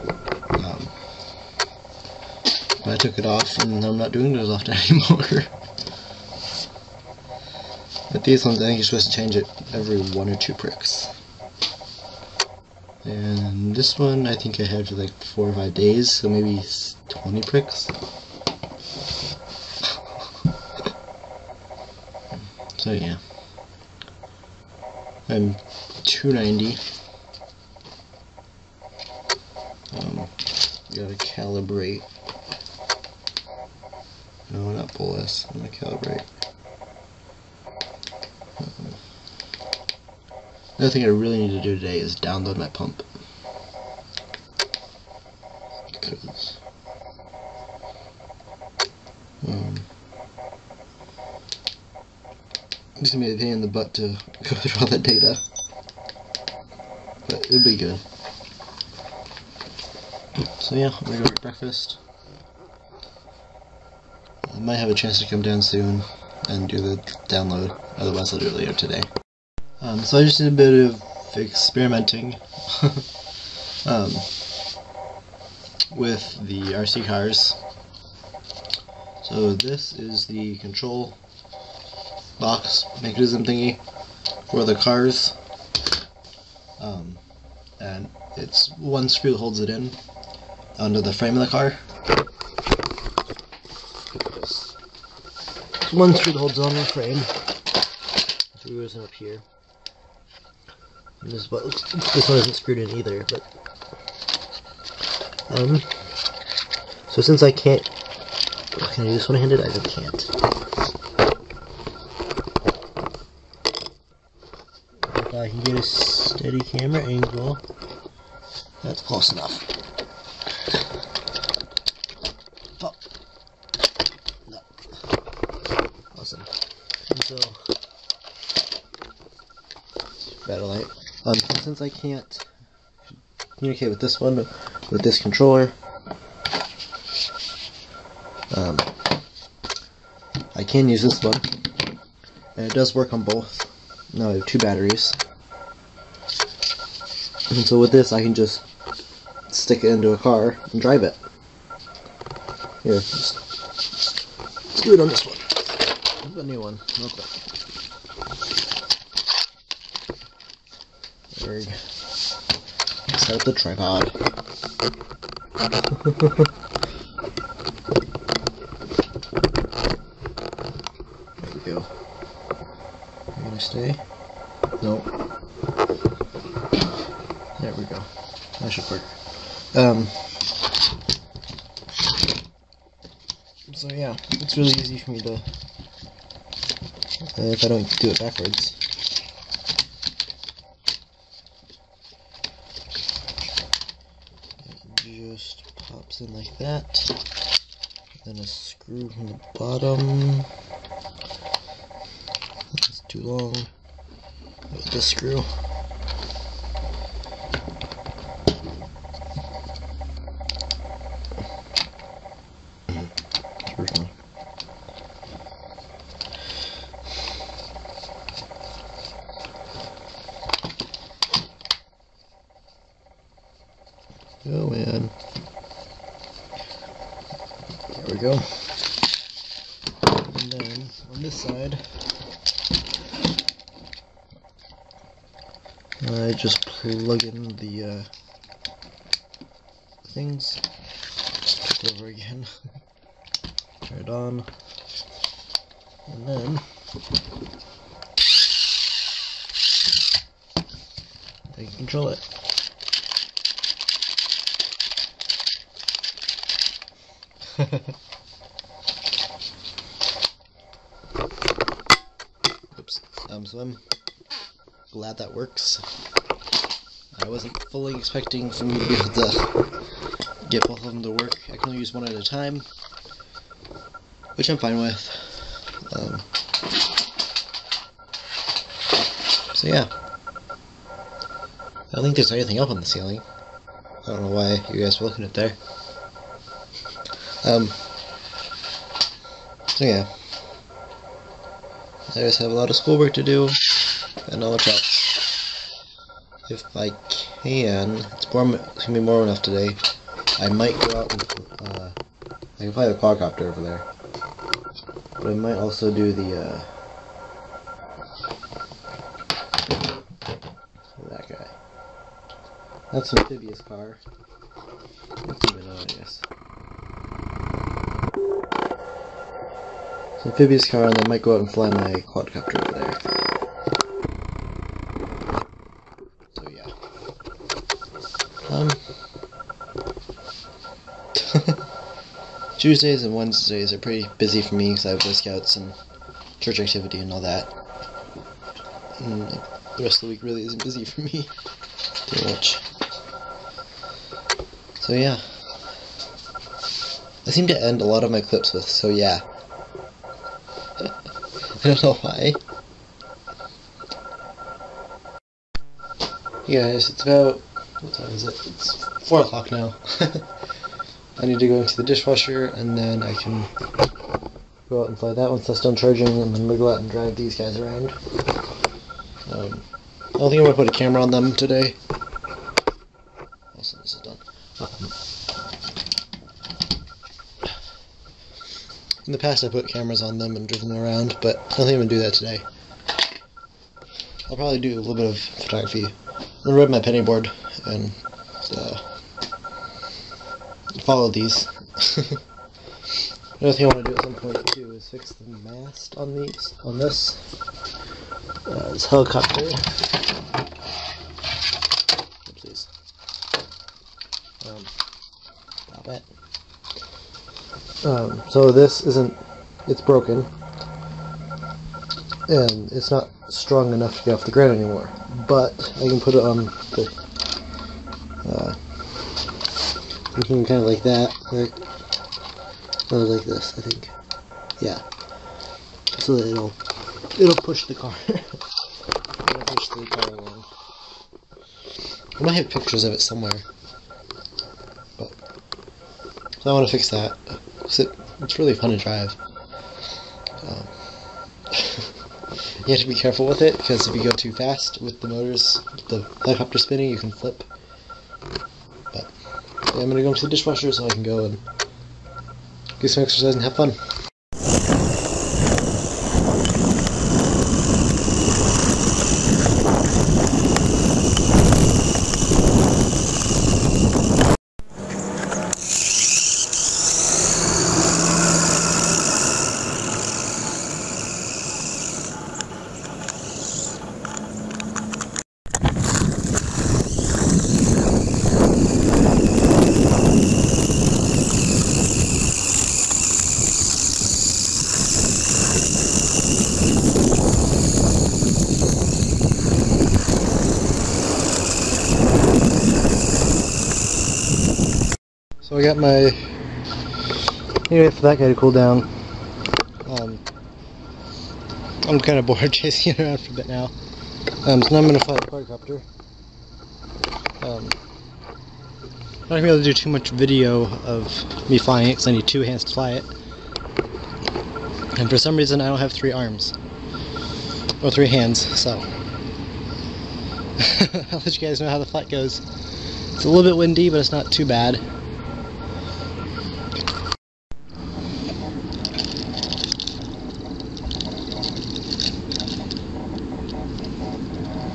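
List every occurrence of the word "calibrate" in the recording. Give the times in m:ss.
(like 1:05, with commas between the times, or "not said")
0:31, 0:35.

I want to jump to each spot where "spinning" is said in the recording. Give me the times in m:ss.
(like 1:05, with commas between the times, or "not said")
7:26.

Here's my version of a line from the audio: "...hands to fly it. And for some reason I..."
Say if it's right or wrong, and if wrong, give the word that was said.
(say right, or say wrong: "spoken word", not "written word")
right.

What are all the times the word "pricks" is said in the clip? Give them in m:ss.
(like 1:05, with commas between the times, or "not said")
0:10, 0:17.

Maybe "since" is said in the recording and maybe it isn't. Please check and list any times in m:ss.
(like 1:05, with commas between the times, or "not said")
1:47, 2:11.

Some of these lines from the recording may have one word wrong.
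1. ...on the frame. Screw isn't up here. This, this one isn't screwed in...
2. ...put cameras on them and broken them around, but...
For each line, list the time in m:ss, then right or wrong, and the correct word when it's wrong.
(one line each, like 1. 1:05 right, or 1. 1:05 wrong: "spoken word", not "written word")
1. 1:36 right
2. 6:19 wrong: "driven", not "broken".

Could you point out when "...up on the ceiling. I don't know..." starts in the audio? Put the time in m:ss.
4:42.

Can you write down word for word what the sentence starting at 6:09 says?
Um, I don't think I'm going to put a camera on them today.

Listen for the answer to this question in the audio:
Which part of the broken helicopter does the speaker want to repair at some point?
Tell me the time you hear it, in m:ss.
6:35.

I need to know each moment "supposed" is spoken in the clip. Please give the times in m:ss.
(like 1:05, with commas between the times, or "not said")
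0:08.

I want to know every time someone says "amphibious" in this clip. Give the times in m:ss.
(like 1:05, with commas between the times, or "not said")
5:13, 5:20.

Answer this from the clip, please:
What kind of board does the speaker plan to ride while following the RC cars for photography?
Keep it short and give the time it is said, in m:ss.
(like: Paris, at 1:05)
penny board, at 6:26.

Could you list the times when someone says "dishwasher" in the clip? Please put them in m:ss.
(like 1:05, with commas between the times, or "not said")
6:01, 7:30.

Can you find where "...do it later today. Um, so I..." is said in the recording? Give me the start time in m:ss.
1:08.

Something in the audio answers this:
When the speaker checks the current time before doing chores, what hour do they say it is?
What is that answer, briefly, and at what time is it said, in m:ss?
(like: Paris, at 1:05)
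4 o'clock, at 5:59.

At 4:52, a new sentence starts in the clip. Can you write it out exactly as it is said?
I just have a lot of schoolwork to do, and not much else.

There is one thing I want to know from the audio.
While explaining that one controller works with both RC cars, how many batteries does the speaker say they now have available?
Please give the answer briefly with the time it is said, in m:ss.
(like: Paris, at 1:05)
2, at 2:24.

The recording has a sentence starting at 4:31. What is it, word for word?
I can only use one at a time, which I'm fine with.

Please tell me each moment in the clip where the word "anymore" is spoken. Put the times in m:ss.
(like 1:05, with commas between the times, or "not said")
0:04, 6:54.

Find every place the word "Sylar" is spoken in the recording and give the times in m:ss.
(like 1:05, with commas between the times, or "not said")
not said.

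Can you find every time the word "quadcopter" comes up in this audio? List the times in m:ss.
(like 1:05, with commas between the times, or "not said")
5:02, 5:22, 8:25.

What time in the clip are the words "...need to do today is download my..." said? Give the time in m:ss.
0:41.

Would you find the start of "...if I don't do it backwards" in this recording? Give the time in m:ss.
3:07.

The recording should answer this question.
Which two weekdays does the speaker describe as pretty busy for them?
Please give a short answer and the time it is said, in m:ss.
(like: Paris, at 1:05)
Tuesdays and Wednesdays, at 5:32.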